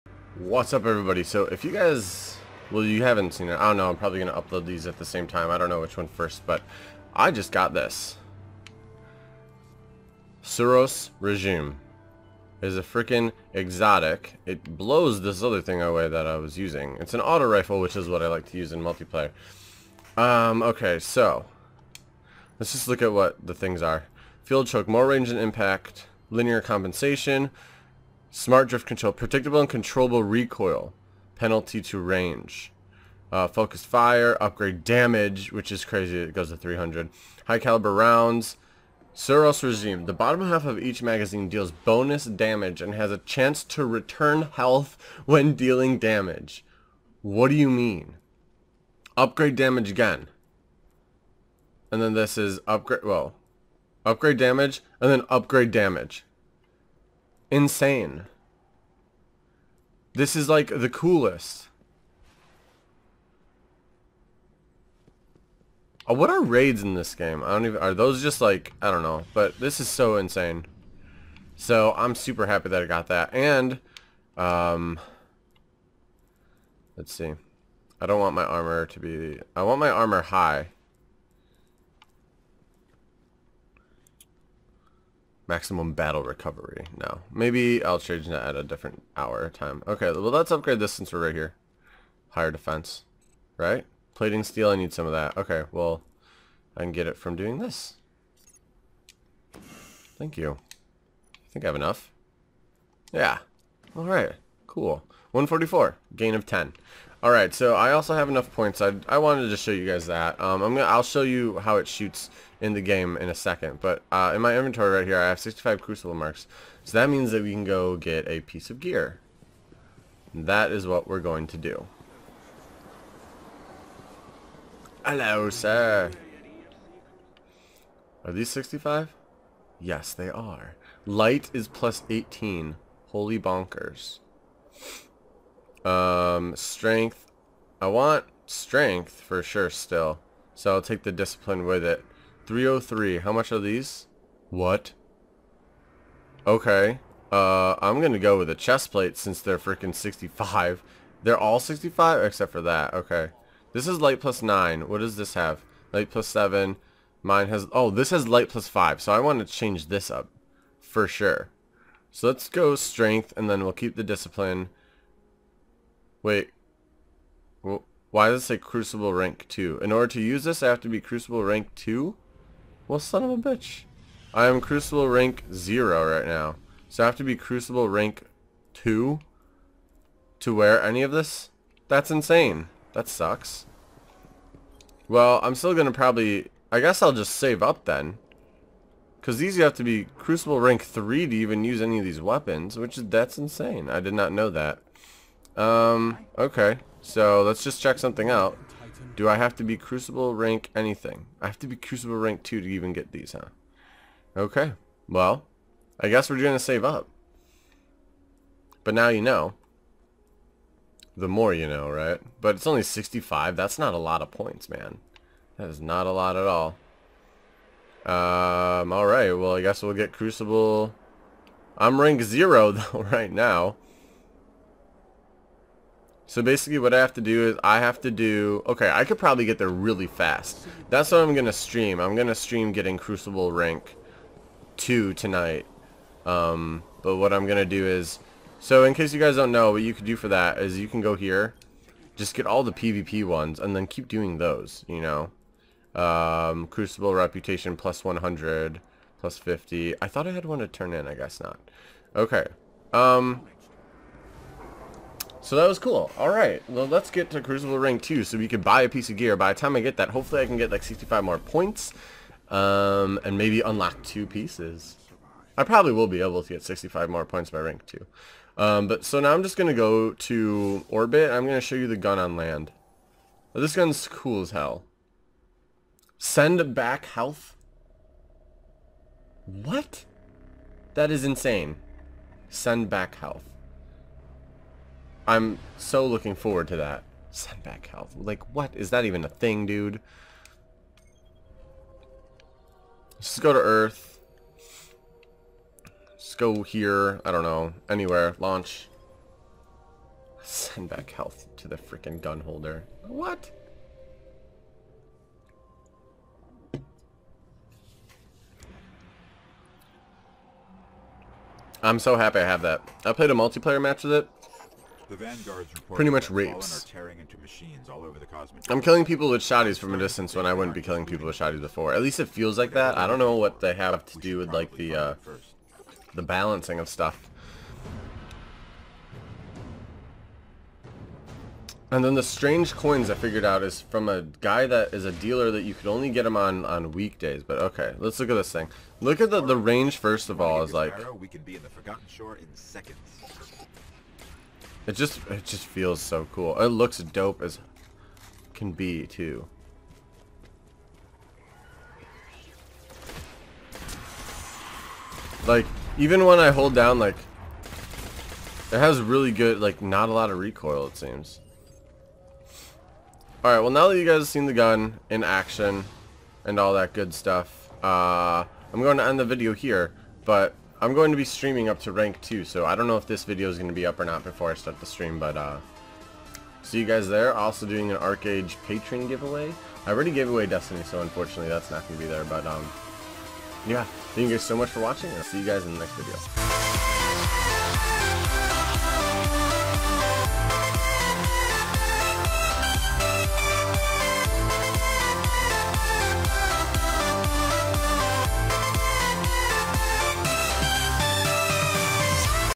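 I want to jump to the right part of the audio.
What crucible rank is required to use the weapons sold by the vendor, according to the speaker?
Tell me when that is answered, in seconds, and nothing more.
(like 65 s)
190 s.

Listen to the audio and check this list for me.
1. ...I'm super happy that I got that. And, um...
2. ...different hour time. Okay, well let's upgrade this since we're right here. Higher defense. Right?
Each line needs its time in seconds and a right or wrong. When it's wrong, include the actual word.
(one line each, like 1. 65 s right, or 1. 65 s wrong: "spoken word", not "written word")
1. 71 s right
2. 88 s right.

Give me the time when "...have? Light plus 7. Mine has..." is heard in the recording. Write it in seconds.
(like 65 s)
155 s.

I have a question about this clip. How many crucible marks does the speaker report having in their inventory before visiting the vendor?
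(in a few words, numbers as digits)
65.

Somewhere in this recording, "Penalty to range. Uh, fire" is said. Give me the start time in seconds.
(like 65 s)
31 s.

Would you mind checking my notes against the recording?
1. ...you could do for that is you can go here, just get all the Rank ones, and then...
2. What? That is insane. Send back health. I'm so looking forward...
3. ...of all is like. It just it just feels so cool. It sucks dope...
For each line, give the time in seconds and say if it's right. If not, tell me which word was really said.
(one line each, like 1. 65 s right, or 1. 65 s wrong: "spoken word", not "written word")
1. 239 s wrong: "PvP", not "Rank"
2. 279 s right
3. 340 s wrong: "looks", not "sucks".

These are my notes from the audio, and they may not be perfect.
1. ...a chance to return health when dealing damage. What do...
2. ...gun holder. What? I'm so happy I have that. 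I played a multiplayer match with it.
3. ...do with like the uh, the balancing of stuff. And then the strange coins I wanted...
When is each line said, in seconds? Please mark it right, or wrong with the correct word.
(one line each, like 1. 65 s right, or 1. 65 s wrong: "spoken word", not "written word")
1. 43 s right
2. 302 s right
3. 324 s wrong: "figured", not "wanted".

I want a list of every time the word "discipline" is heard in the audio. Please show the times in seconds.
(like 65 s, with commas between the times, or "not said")
141 s, 164 s.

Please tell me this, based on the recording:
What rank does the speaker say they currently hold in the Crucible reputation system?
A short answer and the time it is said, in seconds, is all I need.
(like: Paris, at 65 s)
0, at 174 s.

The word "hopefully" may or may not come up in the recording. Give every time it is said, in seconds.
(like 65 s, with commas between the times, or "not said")
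260 s.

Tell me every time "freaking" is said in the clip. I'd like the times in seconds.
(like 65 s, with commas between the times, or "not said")
12 s, 149 s, 301 s.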